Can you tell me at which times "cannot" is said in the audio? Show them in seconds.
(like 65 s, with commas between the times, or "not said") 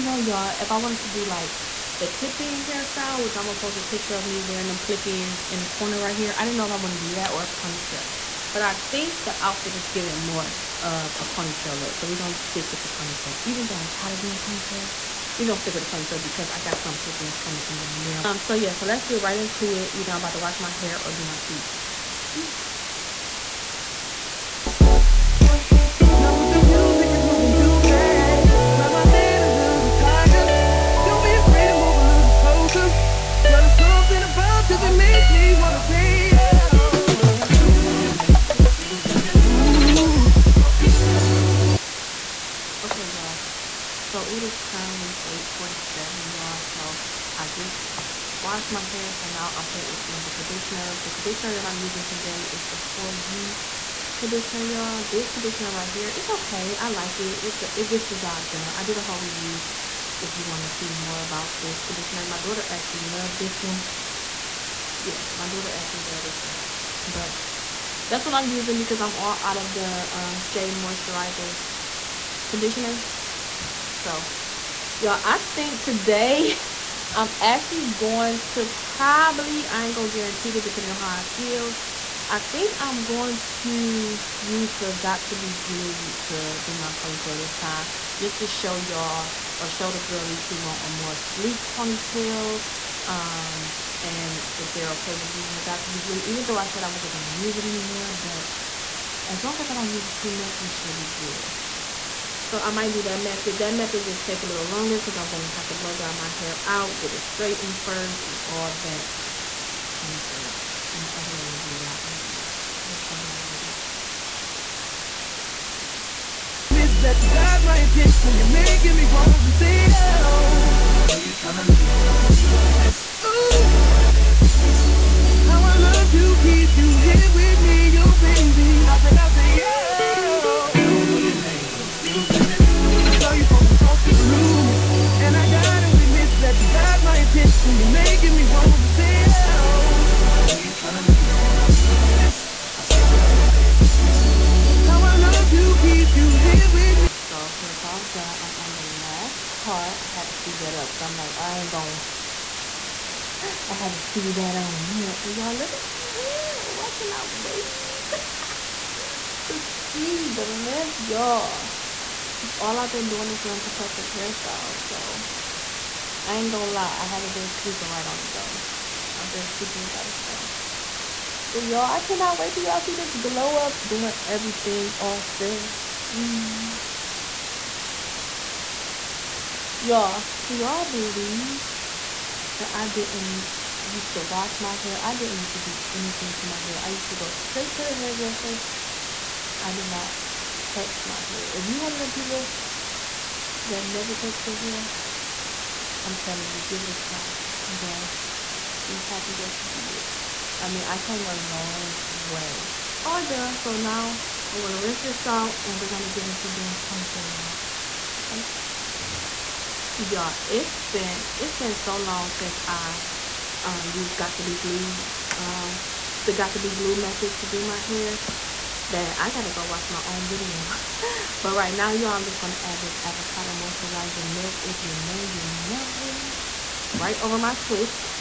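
172 s.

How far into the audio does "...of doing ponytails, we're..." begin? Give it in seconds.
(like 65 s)
14 s.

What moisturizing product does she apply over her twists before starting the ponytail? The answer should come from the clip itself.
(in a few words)
avocado moisturizing milk.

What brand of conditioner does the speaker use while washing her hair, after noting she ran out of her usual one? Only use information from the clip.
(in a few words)
For You.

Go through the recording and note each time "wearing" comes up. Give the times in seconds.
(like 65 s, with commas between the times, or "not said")
4 s, 163 s.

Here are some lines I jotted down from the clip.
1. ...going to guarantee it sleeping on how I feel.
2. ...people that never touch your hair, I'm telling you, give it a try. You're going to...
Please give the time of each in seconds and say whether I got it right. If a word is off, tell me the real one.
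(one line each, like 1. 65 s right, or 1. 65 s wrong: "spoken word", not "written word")
1. 79 s wrong: "depending", not "sleeping"
2. 192 s right.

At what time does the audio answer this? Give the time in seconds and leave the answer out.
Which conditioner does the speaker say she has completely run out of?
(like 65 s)
70 s.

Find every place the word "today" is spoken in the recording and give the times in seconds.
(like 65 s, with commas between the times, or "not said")
52 s, 75 s.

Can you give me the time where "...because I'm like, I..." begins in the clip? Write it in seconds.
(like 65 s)
150 s.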